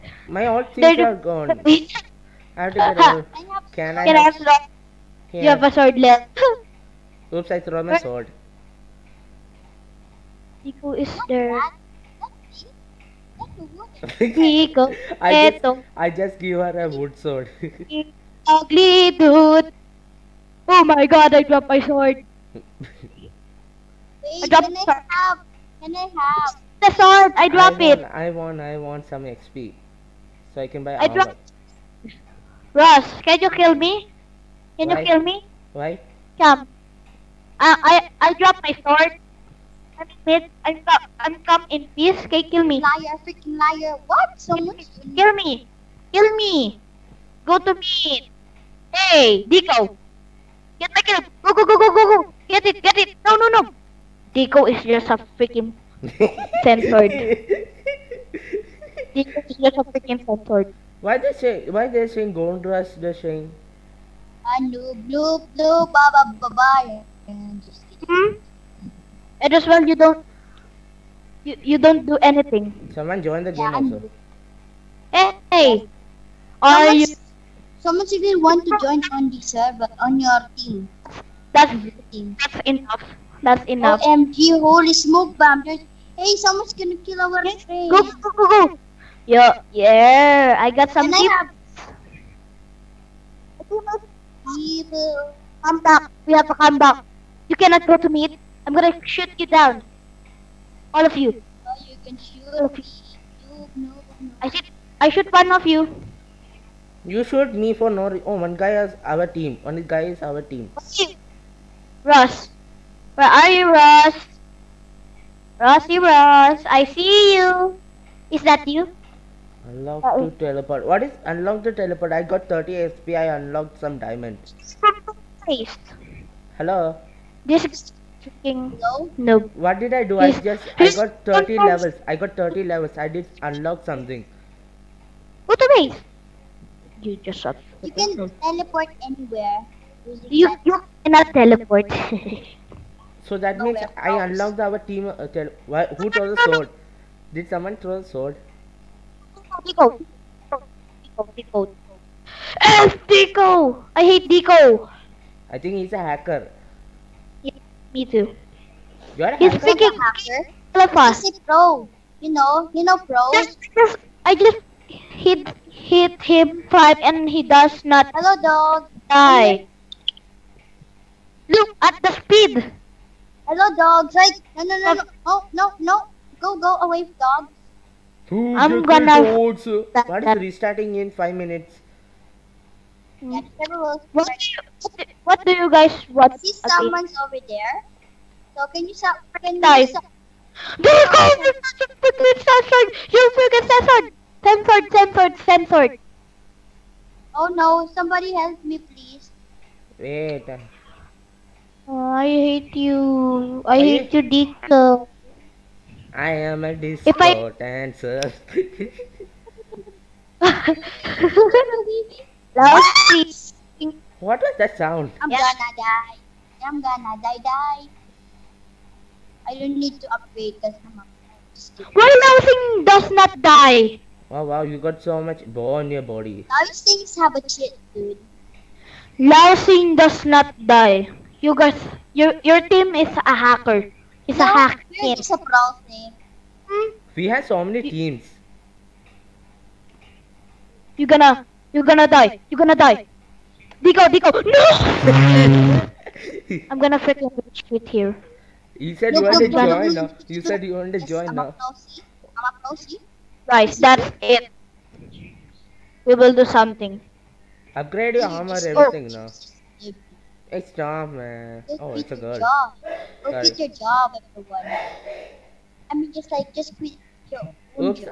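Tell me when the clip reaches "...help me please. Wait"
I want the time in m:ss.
3:18.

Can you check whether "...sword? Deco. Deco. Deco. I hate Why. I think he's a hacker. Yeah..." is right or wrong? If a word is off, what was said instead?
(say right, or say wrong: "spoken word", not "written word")
wrong: "Deco", not "Why".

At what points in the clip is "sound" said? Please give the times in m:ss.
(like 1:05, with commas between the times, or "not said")
3:34.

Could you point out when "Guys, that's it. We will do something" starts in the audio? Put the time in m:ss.
4:13.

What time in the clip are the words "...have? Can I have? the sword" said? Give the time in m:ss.
0:25.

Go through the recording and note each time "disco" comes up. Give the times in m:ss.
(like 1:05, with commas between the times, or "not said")
3:26.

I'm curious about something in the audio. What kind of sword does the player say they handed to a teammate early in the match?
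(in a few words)
wood sword.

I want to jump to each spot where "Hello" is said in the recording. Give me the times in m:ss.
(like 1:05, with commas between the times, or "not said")
2:06, 2:48, 2:53.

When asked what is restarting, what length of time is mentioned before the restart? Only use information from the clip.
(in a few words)
5 minutes.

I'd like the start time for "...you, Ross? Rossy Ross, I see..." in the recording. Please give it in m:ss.
1:53.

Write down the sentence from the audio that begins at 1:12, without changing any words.
Someone join the game yeah, also.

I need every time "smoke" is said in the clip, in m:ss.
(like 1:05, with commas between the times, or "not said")
1:24.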